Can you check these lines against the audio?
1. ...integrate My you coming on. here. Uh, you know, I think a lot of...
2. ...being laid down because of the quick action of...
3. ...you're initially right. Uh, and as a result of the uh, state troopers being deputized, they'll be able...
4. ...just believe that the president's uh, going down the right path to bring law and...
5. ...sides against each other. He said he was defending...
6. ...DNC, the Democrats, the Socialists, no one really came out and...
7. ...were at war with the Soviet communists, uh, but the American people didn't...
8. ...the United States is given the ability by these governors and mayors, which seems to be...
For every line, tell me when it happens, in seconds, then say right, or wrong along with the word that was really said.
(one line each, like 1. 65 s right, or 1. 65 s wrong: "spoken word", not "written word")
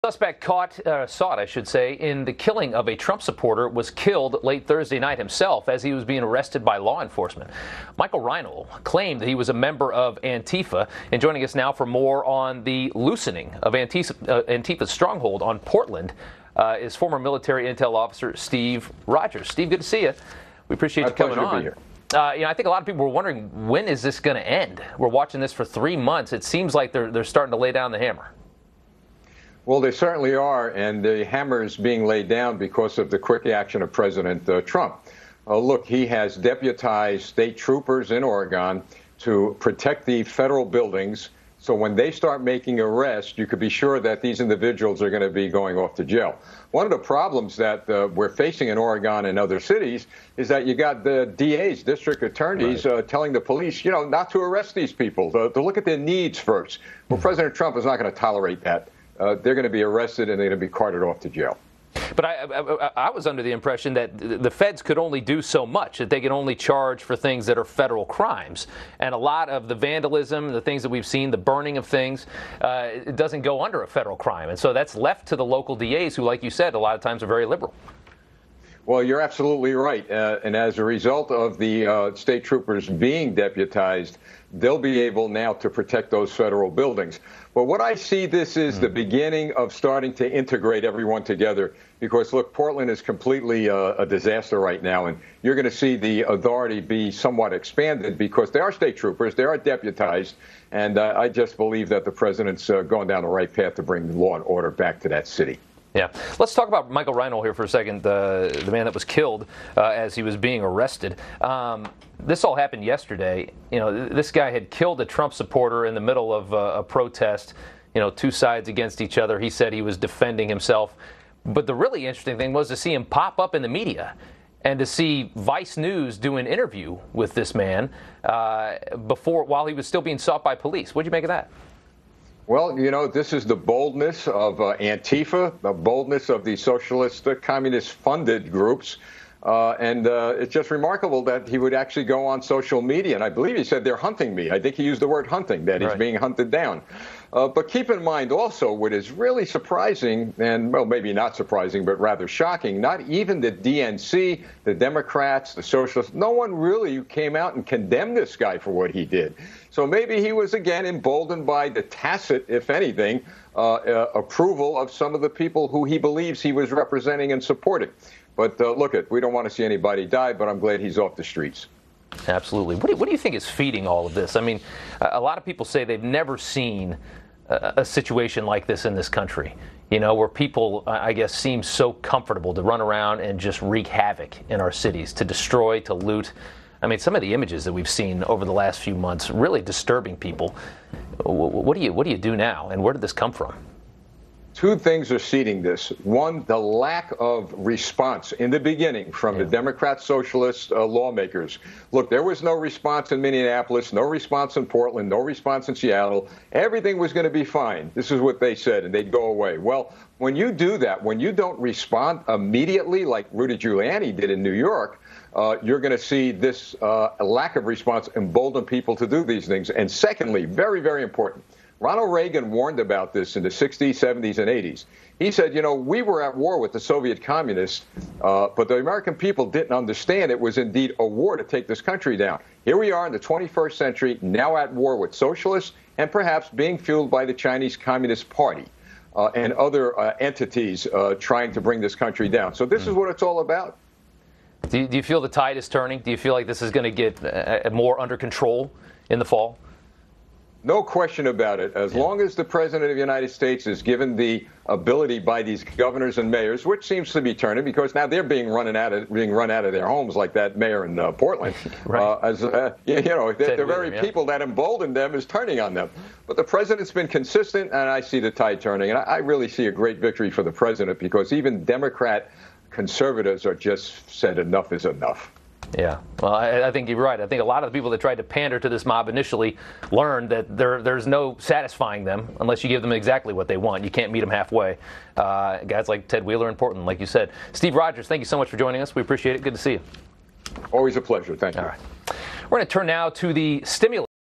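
1. 20 s wrong: "appreciate", not "integrate"
2. 31 s right
3. 79 s wrong: "absolutely", not "initially"
4. 101 s right
5. 118 s right
6. 153 s right
7. 226 s right
8. 252 s right.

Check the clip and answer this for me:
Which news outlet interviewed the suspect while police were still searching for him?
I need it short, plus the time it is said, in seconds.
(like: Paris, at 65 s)
Vice News, at 125 s.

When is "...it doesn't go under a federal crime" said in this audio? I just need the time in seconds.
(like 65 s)
72 s.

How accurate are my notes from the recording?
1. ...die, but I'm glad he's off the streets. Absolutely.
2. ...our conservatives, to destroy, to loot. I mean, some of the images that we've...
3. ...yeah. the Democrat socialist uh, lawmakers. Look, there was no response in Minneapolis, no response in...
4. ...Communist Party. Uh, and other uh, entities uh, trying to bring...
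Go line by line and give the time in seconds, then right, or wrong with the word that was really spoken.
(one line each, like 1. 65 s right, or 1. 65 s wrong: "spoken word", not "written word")
1. 170 s right
2. 184 s wrong: "cities", not "conservatives"
3. 199 s right
4. 237 s right.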